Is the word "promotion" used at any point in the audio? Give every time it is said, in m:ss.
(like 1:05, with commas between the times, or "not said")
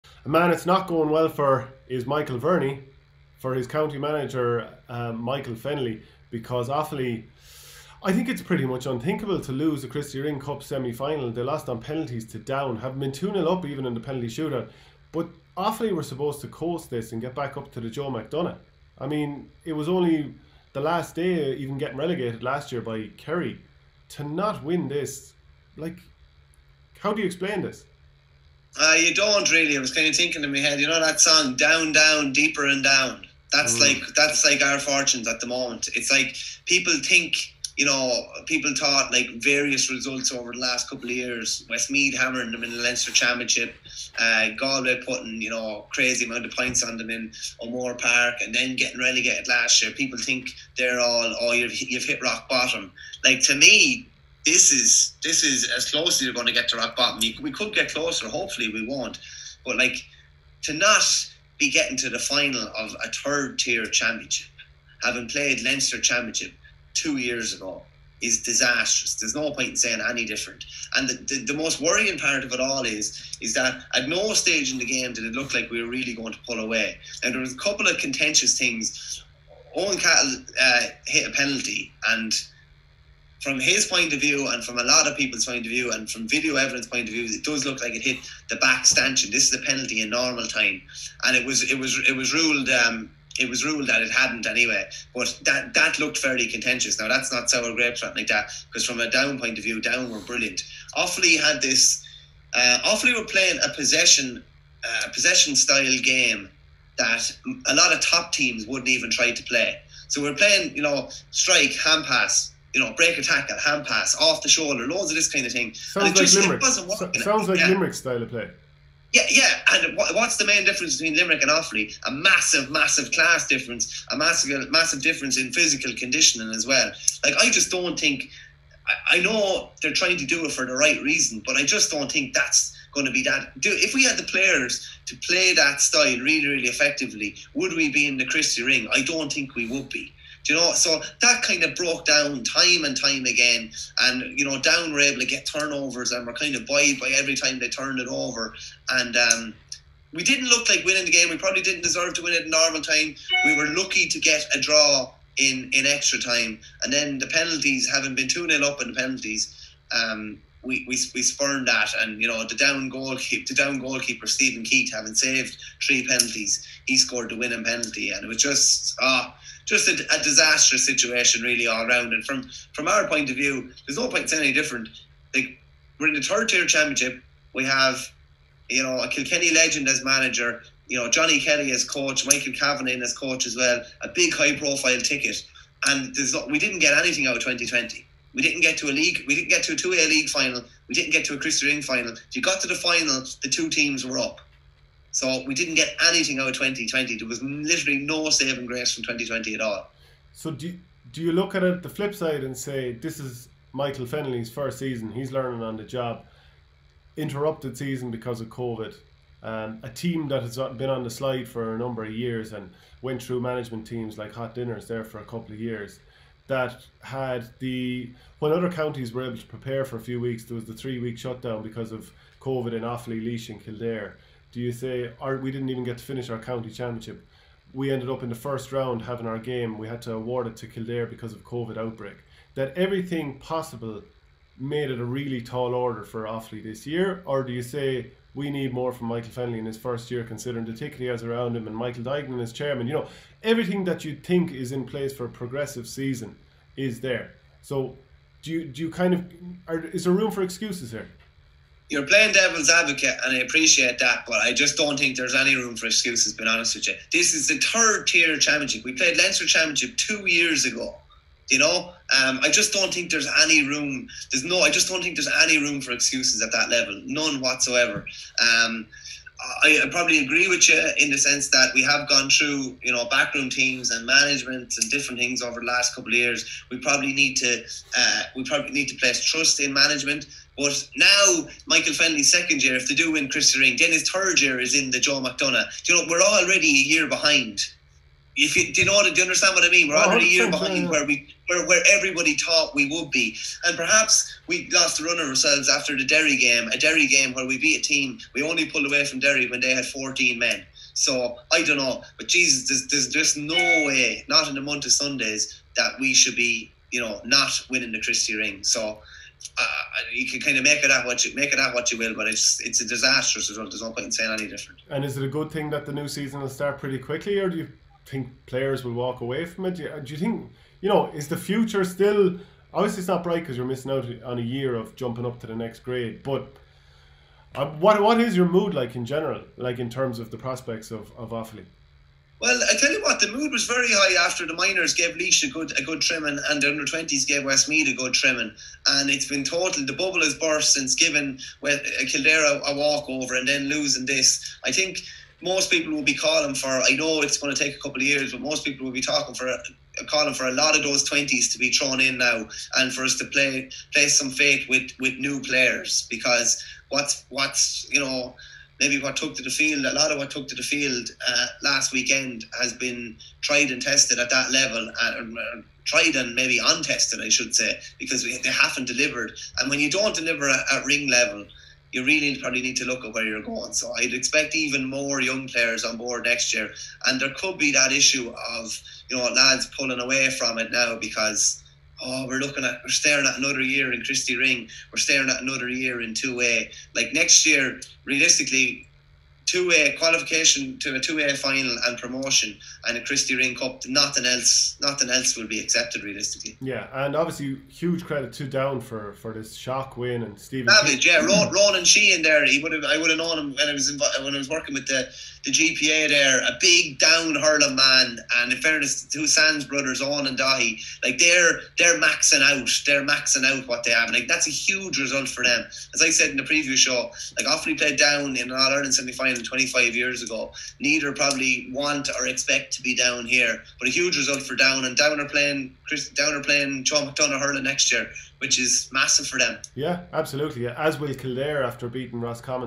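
6:31.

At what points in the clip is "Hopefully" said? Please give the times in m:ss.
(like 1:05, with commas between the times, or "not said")
0:58.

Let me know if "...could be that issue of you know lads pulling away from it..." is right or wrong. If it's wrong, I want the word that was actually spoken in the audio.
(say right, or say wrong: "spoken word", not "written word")
right.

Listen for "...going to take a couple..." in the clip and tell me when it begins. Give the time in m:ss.
5:47.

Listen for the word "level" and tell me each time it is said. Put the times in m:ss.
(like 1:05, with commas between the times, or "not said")
4:26, 6:04, 6:11.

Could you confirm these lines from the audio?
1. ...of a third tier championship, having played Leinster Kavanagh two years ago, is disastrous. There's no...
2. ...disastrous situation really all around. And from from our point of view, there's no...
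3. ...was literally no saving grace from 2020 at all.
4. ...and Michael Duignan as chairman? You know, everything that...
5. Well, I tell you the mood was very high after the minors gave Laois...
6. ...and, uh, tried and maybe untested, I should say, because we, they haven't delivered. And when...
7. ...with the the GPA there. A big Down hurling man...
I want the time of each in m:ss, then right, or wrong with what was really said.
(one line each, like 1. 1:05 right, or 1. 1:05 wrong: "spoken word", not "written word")
1. 1:02 wrong: "Championship", not "Kavanagh"
2. 2:50 right
3. 3:17 right
4. 4:01 right
5. 5:32 right
6. 6:05 right
7. 6:44 right.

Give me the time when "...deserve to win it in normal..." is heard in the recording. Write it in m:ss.
2:31.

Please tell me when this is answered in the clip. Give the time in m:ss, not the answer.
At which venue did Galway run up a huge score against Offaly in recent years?
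0:47.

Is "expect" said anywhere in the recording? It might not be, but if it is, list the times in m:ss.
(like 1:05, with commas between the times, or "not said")
6:14, 7:02.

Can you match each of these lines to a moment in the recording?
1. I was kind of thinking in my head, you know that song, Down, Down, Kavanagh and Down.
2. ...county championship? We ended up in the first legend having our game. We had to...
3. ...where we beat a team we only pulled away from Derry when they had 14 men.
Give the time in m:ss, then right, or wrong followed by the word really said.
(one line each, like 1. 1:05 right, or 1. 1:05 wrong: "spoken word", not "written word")
1. 0:29 wrong: "Deeper", not "Kavanagh"
2. 3:46 wrong: "round", not "legend"
3. 4:57 right.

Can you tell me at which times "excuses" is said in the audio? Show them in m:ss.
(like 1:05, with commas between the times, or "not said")
4:10, 4:15, 4:25.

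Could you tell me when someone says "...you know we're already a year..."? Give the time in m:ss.
4:45.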